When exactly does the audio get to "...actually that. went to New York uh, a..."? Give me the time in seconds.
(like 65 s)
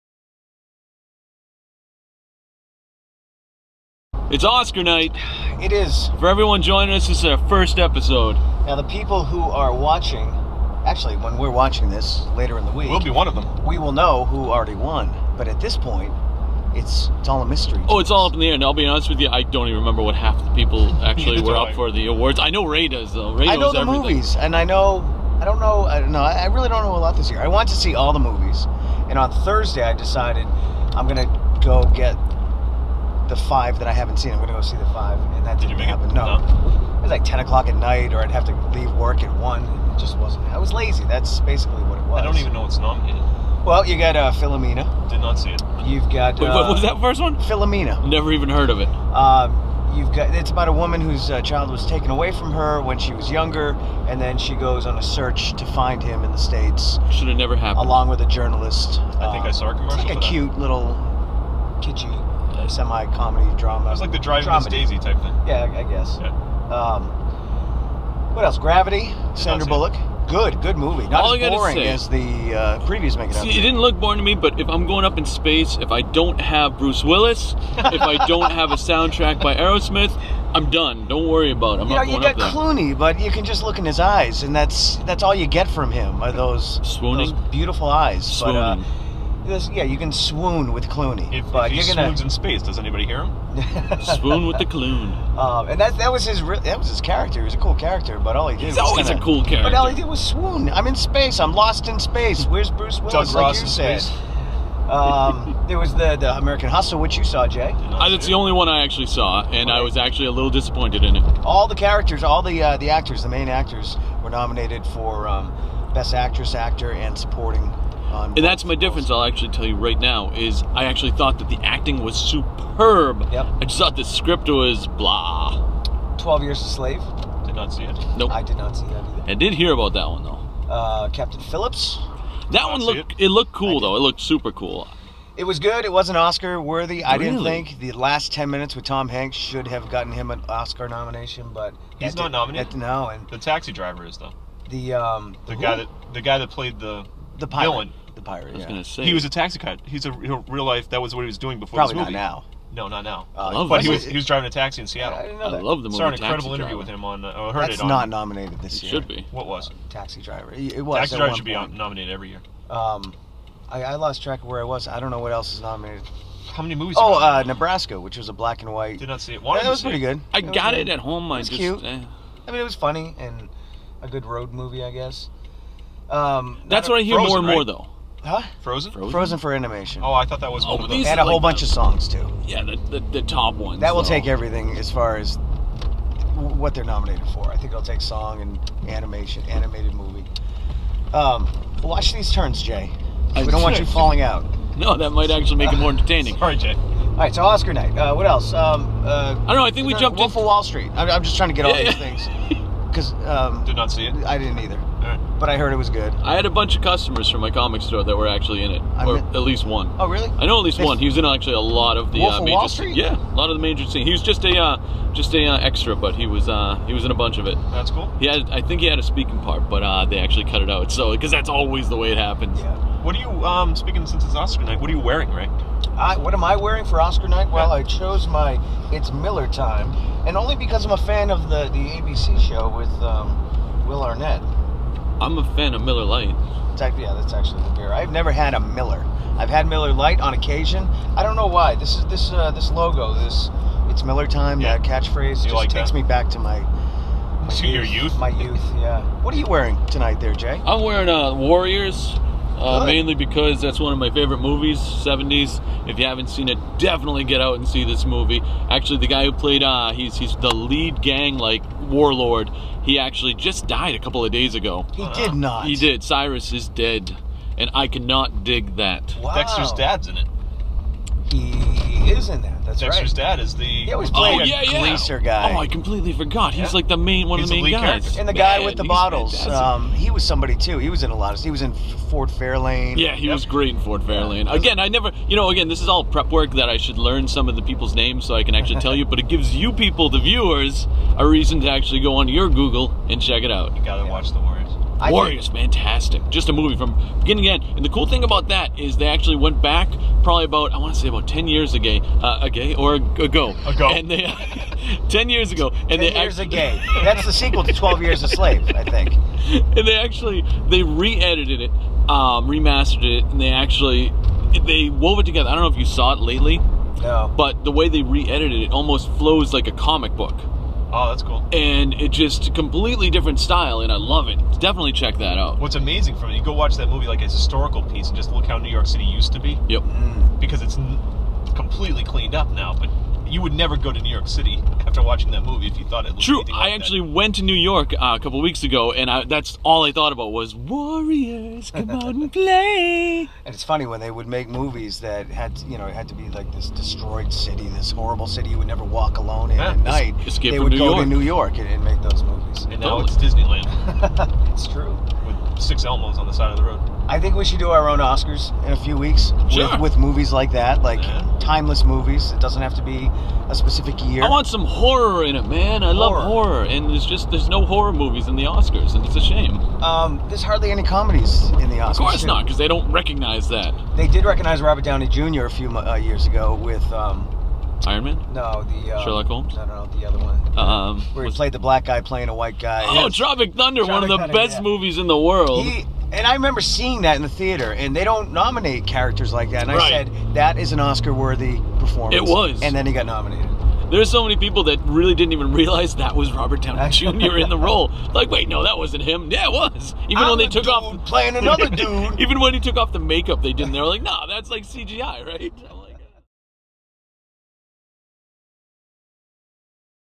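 336 s.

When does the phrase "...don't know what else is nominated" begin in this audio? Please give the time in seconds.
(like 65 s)
165 s.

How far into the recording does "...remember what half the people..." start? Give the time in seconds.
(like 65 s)
19 s.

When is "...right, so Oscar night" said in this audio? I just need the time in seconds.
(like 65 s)
197 s.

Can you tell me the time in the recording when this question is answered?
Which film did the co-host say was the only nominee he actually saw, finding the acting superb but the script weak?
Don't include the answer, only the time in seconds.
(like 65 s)
106 s.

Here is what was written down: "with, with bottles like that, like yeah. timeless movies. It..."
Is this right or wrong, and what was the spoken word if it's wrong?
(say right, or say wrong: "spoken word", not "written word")
wrong: "movies", not "bottles".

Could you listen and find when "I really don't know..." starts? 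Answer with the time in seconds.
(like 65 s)
26 s.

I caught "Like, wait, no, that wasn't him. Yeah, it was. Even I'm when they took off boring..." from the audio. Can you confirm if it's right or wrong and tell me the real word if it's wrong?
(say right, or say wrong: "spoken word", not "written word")
wrong: "playing", not "boring".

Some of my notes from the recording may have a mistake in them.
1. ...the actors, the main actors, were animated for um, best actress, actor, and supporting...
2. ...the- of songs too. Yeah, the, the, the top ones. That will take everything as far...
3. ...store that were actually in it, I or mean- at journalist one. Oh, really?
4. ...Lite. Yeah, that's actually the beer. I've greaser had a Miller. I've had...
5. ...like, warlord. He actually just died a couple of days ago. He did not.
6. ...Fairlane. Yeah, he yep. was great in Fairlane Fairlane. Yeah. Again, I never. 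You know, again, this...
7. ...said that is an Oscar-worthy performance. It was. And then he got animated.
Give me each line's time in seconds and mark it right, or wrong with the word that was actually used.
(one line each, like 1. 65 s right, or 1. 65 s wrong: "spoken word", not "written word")
1. 112 s wrong: "nominated", not "animated"
2. 181 s right
3. 207 s wrong: "least", not "journalist"
4. 236 s wrong: "never", not "greaser"
5. 261 s right
6. 282 s wrong: "Ford", not "Fairlane"
7. 389 s wrong: "nominated", not "animated".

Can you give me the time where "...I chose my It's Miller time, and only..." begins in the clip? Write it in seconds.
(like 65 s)
227 s.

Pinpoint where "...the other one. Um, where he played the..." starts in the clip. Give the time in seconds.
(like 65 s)
379 s.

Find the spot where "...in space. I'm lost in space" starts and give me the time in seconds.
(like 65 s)
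100 s.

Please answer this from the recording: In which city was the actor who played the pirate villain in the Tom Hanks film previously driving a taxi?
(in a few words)
Seattle.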